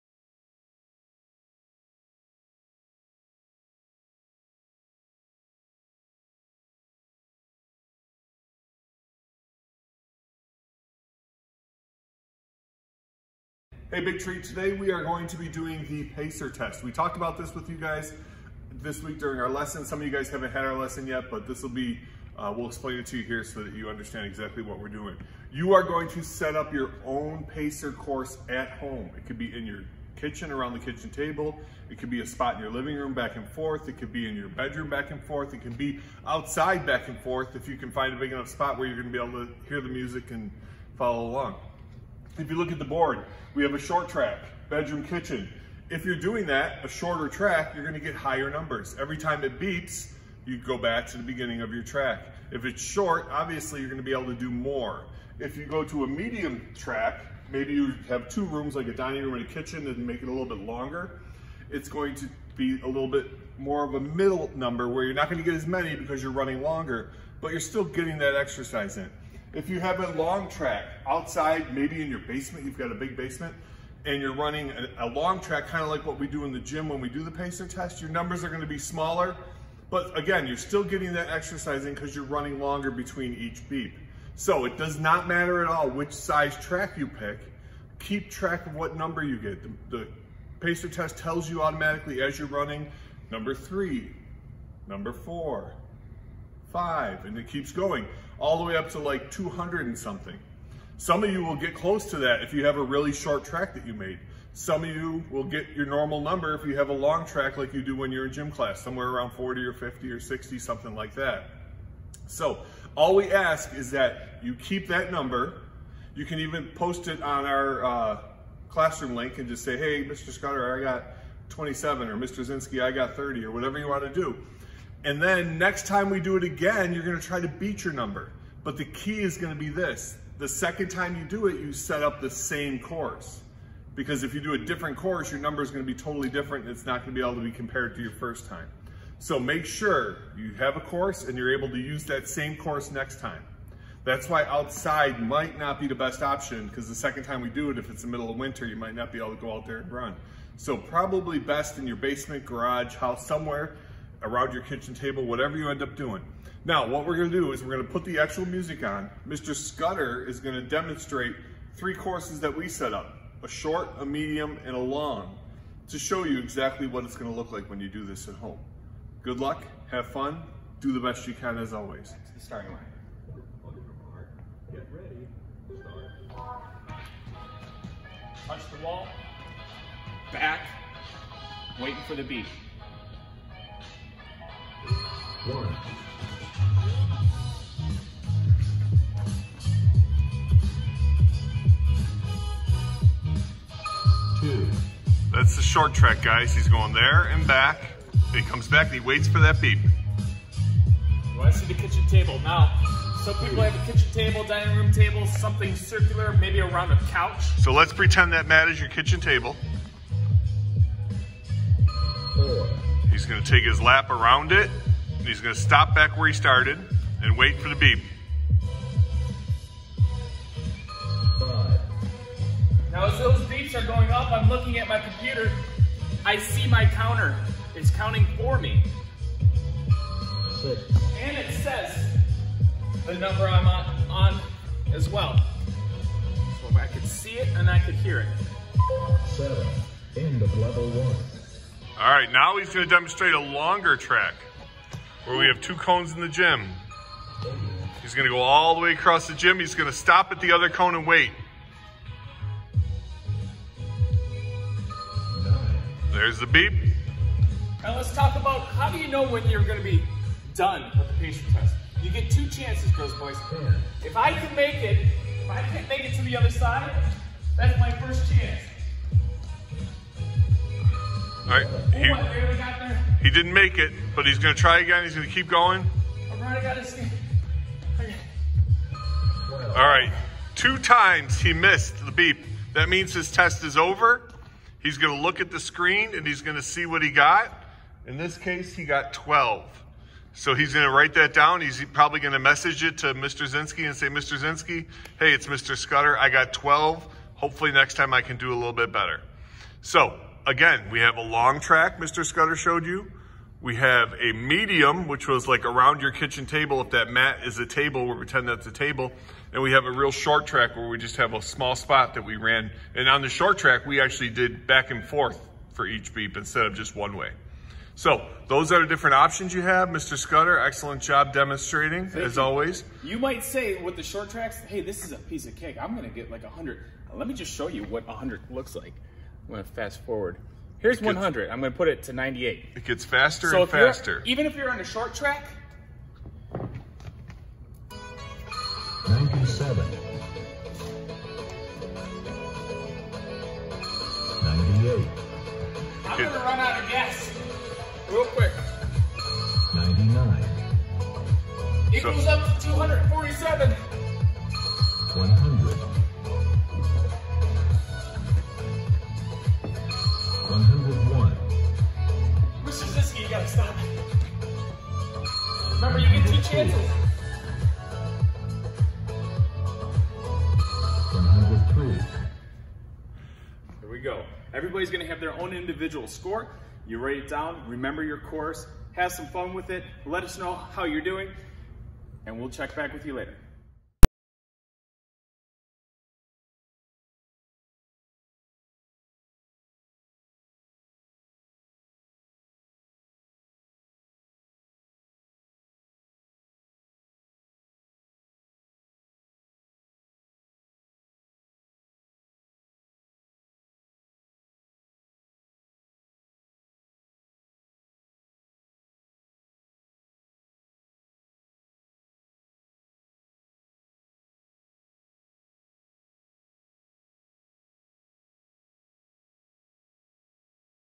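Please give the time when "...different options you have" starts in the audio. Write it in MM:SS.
05:18.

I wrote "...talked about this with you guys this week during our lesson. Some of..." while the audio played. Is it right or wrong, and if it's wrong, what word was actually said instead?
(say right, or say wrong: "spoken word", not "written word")
right.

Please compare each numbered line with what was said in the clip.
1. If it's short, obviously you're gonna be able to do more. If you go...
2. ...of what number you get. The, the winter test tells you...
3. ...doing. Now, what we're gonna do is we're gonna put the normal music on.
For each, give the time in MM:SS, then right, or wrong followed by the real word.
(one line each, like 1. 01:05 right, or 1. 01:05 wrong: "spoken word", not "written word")
1. 00:52 right
2. 01:28 wrong: "pacer", not "winter"
3. 02:35 wrong: "actual", not "normal".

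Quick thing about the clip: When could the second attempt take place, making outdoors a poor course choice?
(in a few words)
middle of winter.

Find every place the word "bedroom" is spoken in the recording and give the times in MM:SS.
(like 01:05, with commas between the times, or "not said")
00:34, 00:44.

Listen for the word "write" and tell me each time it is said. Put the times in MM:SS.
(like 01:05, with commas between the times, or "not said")
04:50, 06:16.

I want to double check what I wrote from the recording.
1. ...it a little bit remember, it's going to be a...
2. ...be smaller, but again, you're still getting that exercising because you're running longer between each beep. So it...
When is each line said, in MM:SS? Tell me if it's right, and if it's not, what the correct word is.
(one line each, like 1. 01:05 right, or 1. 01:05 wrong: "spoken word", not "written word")
1. 01:00 wrong: "longer", not "remember"
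2. 01:18 right.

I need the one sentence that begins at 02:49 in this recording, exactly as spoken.
Good luck, have fun, do the best you can as always.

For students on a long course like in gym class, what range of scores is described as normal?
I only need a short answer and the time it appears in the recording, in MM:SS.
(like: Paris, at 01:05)
40 to 60, at 01:49.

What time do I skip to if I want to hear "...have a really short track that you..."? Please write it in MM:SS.
01:42.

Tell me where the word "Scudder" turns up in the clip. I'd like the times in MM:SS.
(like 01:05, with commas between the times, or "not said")
02:00, 02:39, 04:55, 05:02, 05:20.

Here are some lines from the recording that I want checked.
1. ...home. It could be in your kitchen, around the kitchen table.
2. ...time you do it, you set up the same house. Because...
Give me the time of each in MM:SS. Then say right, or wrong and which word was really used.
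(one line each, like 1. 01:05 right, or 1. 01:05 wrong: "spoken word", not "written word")
1. 00:28 right
2. 02:10 wrong: "course", not "house".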